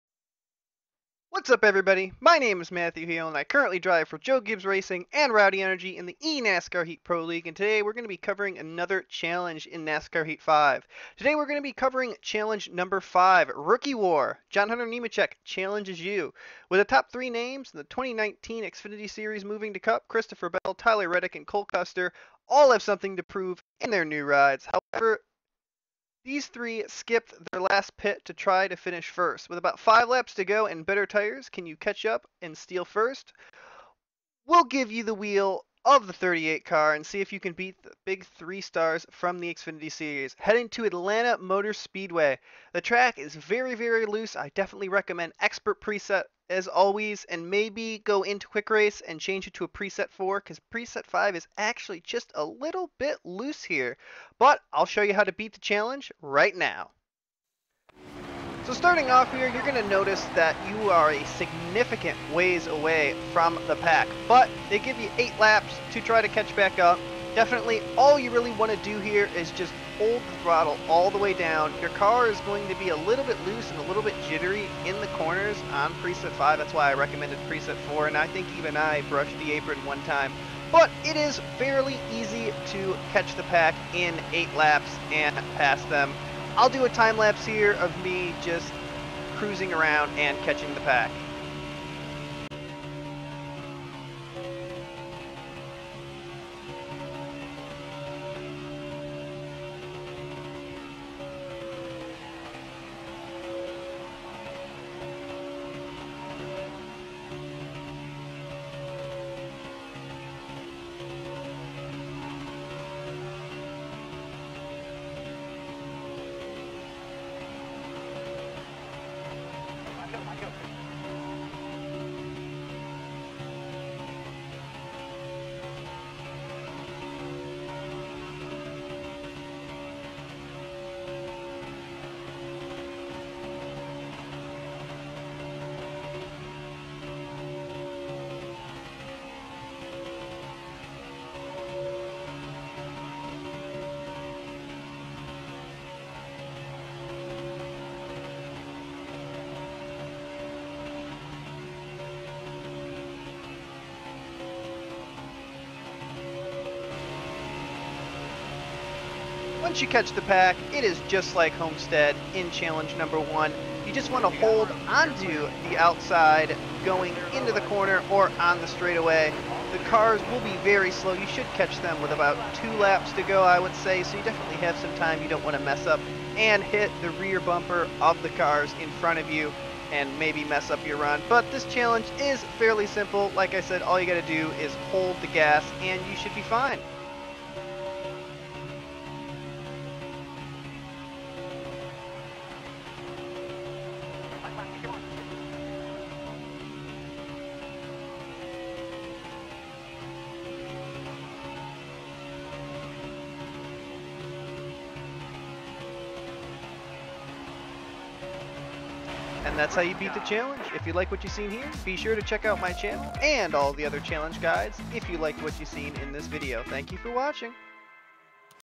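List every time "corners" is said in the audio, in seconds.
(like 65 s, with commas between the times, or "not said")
75 s, 167 s.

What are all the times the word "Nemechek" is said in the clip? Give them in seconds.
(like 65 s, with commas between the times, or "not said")
14 s.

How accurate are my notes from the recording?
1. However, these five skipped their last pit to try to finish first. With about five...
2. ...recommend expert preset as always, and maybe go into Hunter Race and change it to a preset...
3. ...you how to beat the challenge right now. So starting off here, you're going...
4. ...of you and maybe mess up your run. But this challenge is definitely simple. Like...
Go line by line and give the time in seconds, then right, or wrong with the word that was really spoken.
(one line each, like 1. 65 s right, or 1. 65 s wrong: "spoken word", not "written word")
1. 24 s wrong: "three", not "five"
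2. 44 s wrong: "Quick", not "Hunter"
3. 55 s right
4. 179 s wrong: "fairly", not "definitely".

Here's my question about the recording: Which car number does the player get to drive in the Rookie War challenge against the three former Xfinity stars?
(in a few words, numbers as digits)
38.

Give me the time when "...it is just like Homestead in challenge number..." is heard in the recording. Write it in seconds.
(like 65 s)
160 s.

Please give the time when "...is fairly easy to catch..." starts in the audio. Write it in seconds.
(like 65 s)
81 s.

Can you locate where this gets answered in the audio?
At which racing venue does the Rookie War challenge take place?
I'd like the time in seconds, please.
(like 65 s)
40 s.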